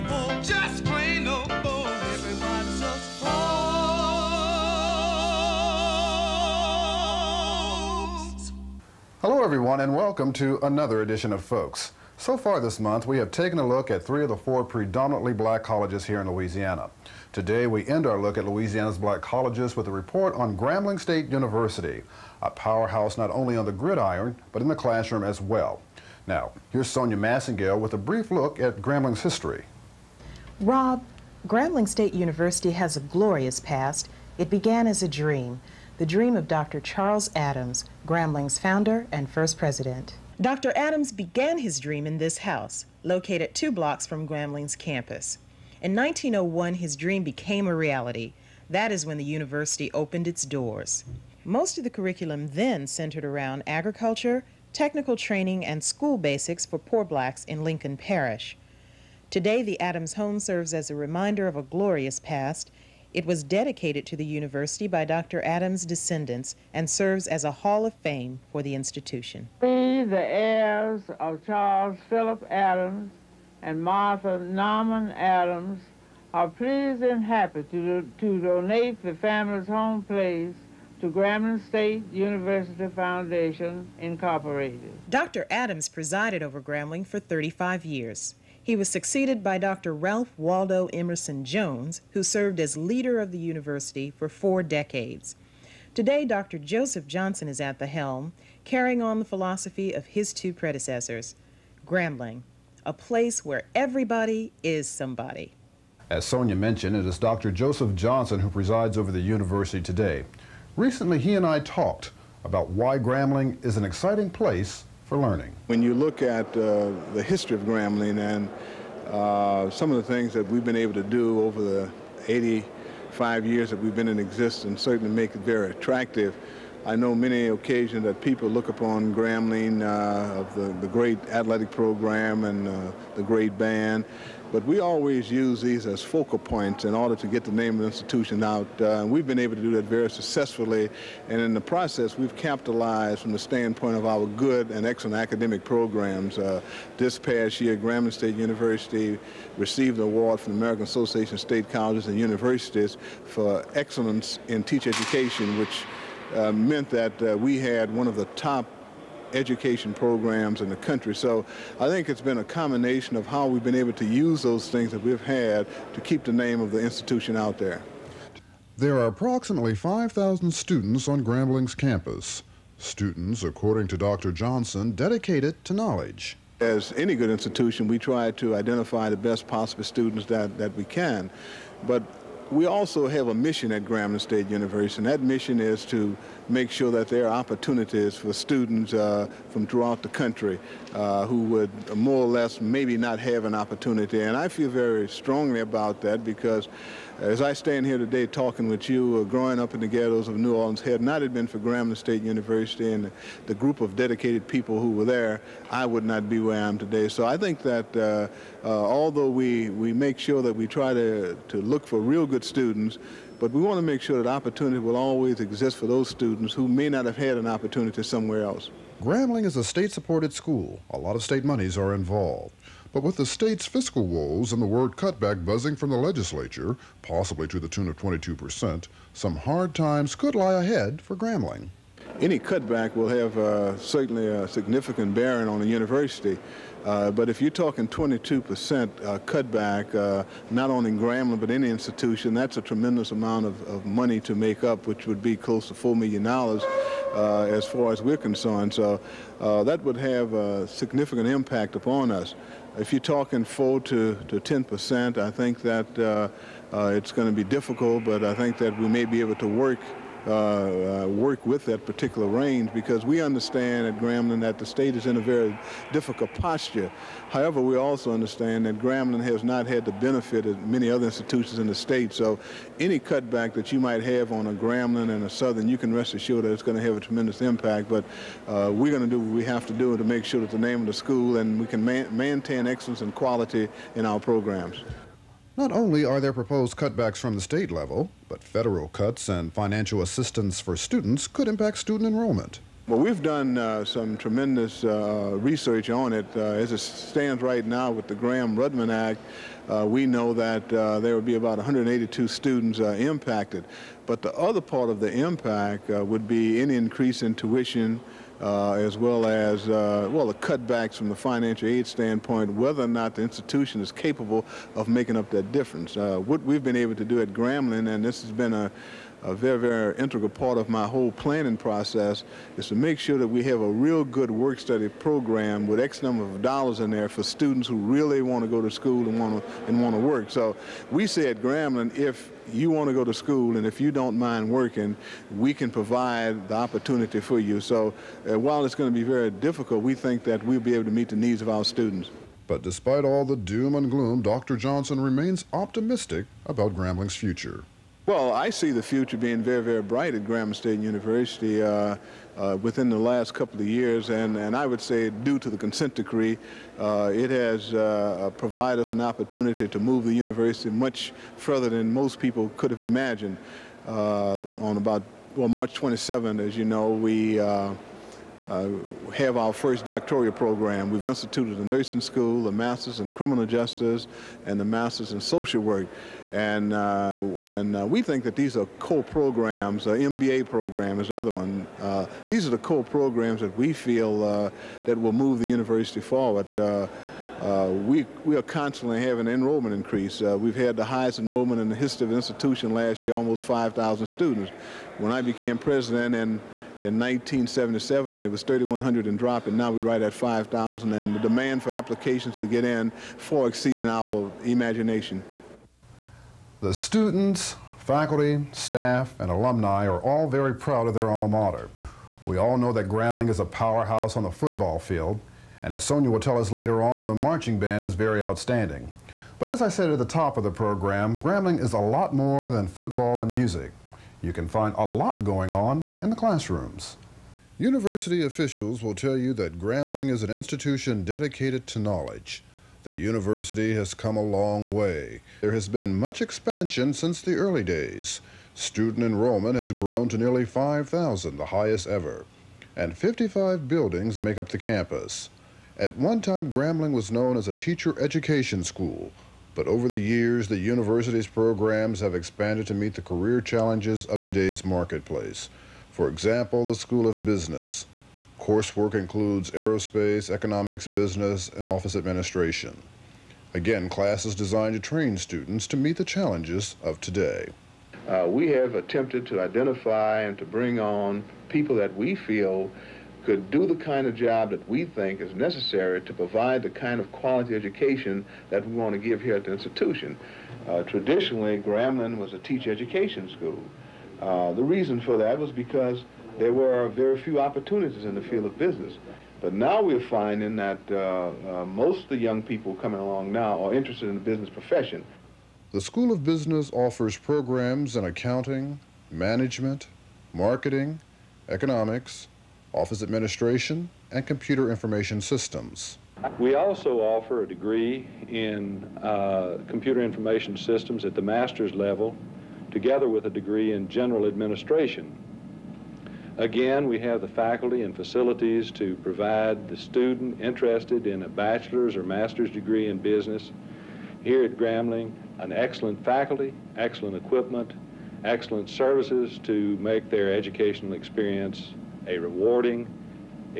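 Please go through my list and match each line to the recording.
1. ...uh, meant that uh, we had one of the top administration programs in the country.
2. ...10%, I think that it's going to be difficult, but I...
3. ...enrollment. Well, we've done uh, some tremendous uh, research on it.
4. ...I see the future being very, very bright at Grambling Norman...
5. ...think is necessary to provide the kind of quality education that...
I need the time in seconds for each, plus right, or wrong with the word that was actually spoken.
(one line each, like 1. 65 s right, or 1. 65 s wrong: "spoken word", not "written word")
1. 156 s wrong: "education", not "administration"
2. 254 s right
3. 292 s right
4. 348 s wrong: "State", not "Norman"
5. 474 s right.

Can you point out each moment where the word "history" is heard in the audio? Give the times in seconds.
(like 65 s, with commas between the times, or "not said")
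29 s, 117 s, 391 s.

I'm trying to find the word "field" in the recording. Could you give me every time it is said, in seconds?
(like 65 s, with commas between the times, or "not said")
414 s, 488 s.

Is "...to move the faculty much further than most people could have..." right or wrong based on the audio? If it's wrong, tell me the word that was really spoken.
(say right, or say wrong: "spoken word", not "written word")
wrong: "university", not "faculty".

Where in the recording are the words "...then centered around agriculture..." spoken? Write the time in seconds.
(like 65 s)
52 s.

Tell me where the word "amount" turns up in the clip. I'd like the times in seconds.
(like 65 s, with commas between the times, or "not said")
243 s.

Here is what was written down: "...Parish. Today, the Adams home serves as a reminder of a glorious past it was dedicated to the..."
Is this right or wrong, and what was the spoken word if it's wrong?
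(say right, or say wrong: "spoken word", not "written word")
right.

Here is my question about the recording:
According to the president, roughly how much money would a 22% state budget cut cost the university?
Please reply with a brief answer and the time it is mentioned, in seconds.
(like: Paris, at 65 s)
$4 million, at 245 s.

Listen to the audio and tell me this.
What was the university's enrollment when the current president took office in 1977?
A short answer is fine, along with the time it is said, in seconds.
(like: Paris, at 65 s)
3,100, at 398 s.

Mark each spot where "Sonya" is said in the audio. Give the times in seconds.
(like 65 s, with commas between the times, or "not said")
26 s, 106 s, 415 s.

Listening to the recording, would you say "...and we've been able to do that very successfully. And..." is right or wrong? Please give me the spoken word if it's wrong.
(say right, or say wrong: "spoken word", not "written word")
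right.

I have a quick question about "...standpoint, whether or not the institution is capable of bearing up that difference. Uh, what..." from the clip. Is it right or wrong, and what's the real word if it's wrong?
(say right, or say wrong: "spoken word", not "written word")
wrong: "making", not "bearing".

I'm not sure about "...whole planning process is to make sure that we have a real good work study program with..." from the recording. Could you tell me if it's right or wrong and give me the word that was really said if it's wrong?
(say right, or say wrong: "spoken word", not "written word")
right.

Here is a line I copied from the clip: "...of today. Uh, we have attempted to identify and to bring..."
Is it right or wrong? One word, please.
right.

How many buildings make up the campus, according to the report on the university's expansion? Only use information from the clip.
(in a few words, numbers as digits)
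55.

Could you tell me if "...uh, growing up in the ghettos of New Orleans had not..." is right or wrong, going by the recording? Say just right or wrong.
right.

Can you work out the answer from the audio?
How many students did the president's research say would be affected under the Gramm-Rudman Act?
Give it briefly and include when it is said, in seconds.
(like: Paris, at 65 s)
182, at 301 s.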